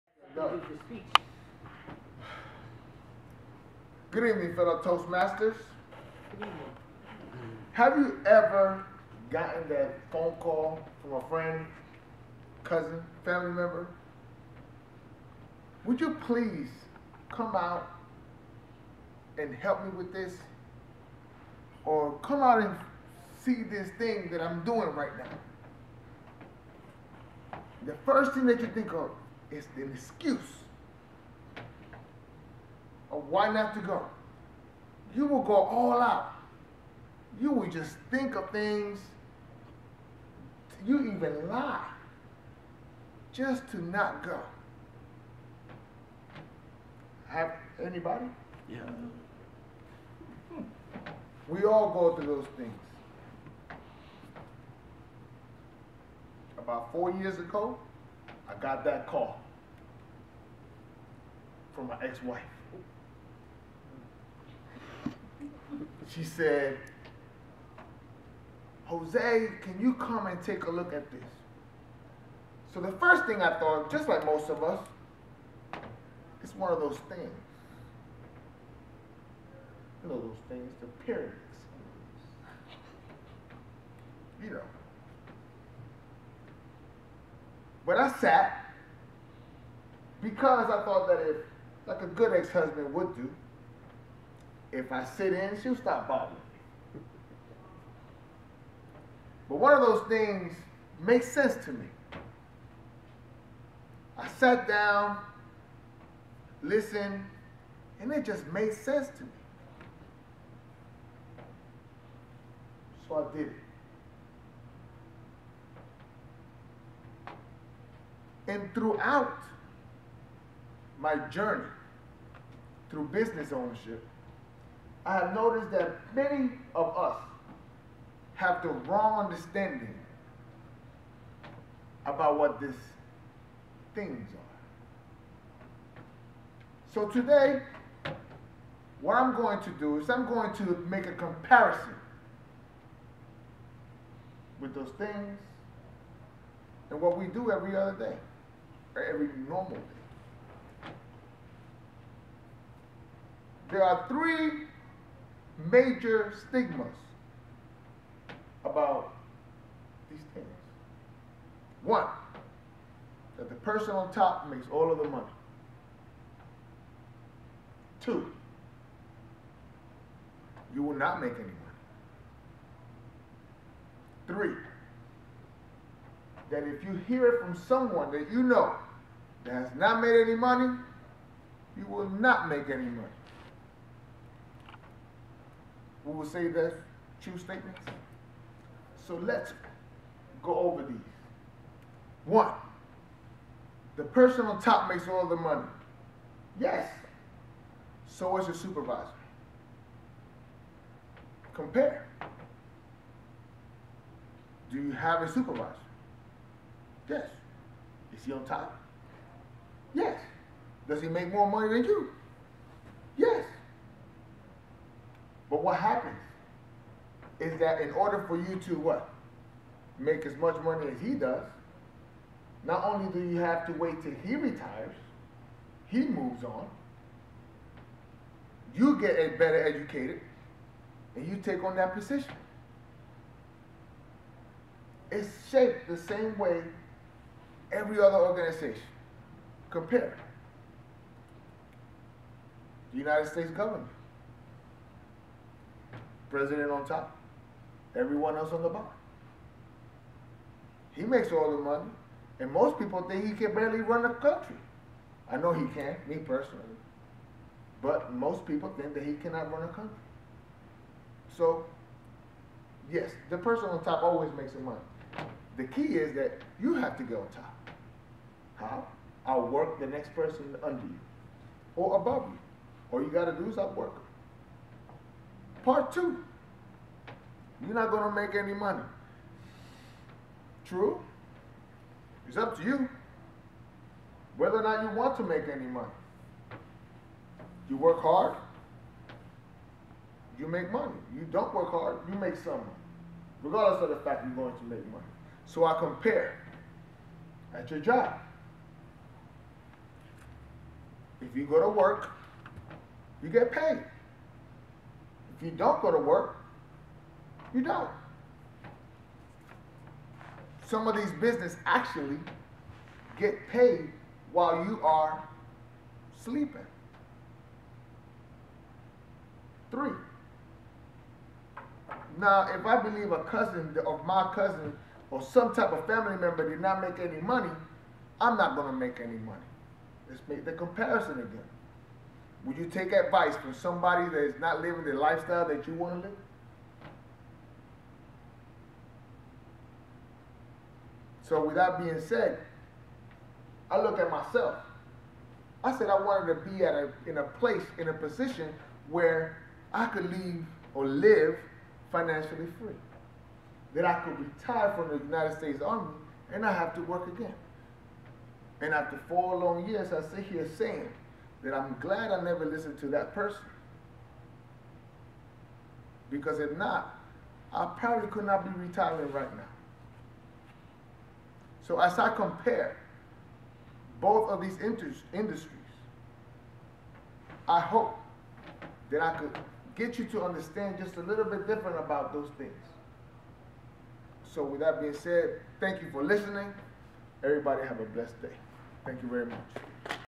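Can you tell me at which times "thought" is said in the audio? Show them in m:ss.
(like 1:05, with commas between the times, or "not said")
1:13, 1:30.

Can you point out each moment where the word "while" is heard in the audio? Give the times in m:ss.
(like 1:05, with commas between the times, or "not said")
5:14.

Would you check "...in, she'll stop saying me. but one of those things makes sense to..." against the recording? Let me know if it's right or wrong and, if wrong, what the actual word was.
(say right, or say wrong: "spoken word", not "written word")
wrong: "bothering", not "saying".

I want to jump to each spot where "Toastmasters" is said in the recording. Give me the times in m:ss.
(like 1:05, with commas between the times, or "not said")
0:04.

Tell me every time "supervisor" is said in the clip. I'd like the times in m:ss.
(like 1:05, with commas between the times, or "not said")
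3:18, 3:25.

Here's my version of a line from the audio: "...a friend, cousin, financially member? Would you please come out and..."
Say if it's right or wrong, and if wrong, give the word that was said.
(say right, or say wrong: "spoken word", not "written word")
wrong: "family", not "financially".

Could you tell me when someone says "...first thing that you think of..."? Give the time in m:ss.
0:28.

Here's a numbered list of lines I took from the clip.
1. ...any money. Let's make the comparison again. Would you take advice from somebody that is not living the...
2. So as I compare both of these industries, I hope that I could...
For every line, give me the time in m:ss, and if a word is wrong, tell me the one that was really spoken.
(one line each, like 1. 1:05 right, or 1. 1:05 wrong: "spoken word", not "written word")
1. 5:29 right
2. 6:11 right.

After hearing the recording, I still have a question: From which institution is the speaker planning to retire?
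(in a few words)
The United States Army.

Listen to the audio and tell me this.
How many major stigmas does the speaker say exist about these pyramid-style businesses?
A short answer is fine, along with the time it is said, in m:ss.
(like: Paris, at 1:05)
3, at 2:34.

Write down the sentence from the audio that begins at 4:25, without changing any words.
The key is that you have to get on top outwork the next person under you or above you.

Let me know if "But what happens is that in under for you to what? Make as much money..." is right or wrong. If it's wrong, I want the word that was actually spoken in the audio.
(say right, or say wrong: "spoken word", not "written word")
wrong: "order", not "under".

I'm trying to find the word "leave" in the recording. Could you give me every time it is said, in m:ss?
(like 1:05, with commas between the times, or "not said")
5:50.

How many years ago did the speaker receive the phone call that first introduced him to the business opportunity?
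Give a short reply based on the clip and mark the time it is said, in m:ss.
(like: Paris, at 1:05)
4, at 0:56.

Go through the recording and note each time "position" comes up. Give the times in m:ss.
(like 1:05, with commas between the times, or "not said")
3:51, 5:47.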